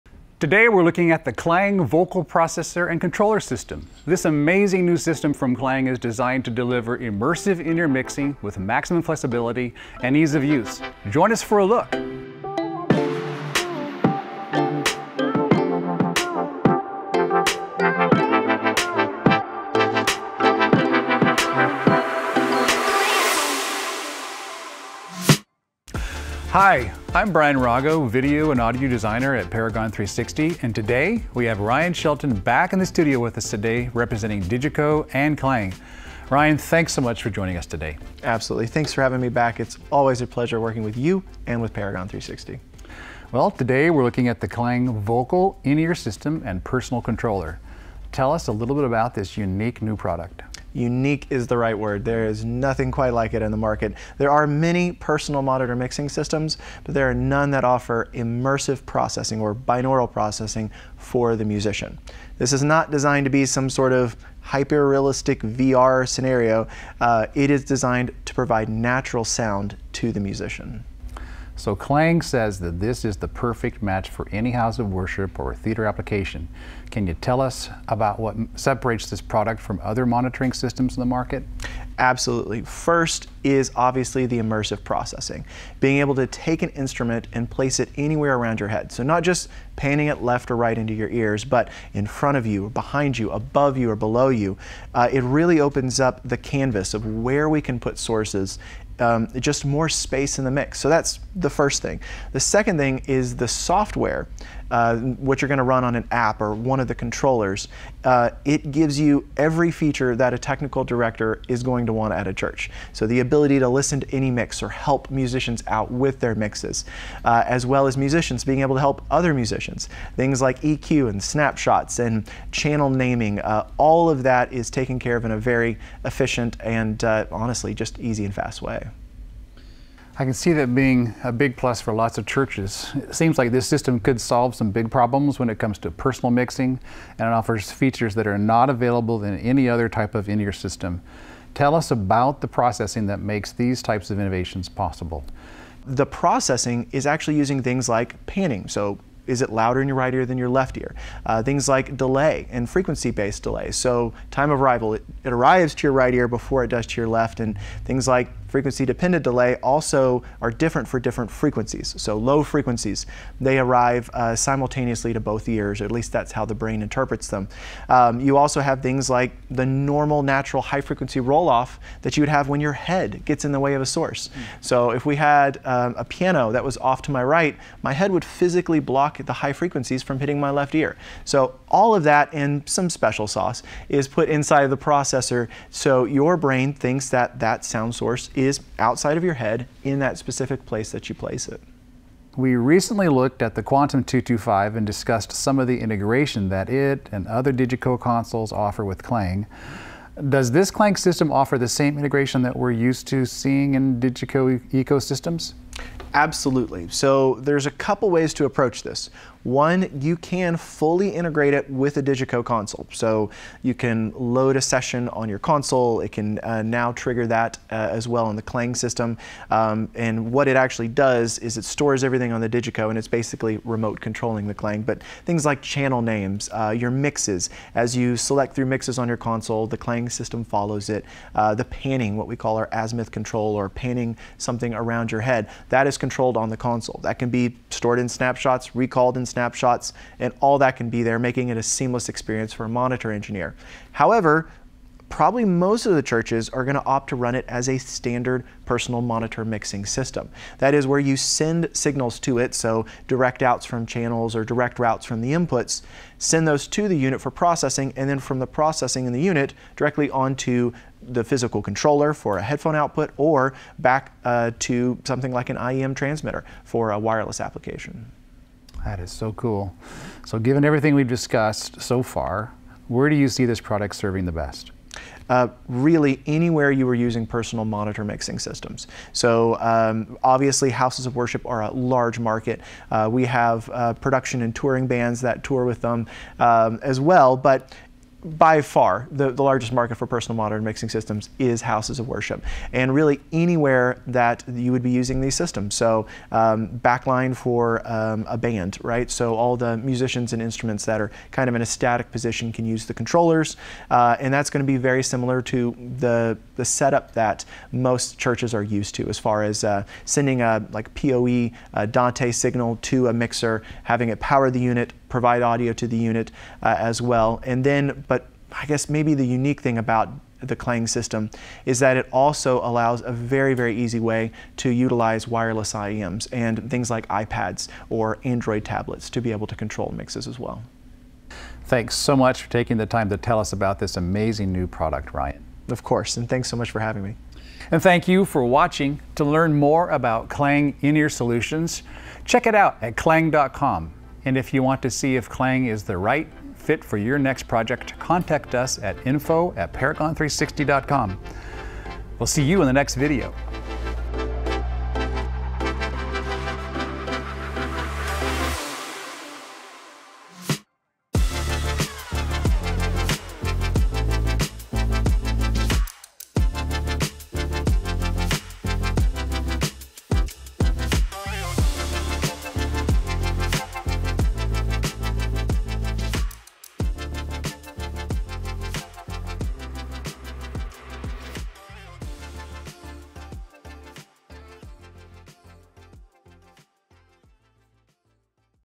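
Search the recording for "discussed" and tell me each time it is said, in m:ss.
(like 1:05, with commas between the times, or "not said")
3:14, 4:31.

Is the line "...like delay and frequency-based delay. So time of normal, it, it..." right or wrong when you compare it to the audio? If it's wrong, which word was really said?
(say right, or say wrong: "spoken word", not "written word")
wrong: "arrival", not "normal".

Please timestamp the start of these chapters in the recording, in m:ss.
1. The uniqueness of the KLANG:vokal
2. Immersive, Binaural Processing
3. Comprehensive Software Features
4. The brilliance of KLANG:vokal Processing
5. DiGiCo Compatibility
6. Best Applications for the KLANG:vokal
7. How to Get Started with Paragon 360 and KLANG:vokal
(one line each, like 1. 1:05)
1. 0:43
2. 1:23
3. 1:42
4. 2:22
5. 3:13
6. 4:29
7. 5:32.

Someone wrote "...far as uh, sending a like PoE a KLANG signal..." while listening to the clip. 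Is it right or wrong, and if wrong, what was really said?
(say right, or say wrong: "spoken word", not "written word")
wrong: "Dante", not "KLANG".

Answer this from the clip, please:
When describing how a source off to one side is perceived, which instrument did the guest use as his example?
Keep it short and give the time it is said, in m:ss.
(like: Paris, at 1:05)
piano, at 2:56.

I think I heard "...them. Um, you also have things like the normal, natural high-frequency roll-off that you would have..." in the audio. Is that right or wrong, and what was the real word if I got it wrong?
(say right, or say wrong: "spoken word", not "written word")
right.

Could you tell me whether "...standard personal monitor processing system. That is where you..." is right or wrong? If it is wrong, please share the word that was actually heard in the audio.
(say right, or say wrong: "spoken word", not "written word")
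wrong: "mixing", not "processing".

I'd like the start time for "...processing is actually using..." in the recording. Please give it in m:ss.
2:26.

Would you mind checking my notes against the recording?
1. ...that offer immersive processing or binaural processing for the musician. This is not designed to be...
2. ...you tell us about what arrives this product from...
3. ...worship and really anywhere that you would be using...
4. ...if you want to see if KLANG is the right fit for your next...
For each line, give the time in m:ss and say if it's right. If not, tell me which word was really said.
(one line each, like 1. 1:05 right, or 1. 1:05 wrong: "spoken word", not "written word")
1. 0:57 right
2. 1:17 wrong: "separates", not "arrives"
3. 4:52 right
4. 5:44 right.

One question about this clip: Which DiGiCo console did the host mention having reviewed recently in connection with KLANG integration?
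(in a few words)
Quantum 225.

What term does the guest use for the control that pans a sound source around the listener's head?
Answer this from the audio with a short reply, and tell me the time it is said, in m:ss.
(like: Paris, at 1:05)
azimuth control, at 3:52.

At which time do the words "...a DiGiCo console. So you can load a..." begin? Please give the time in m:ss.
3:31.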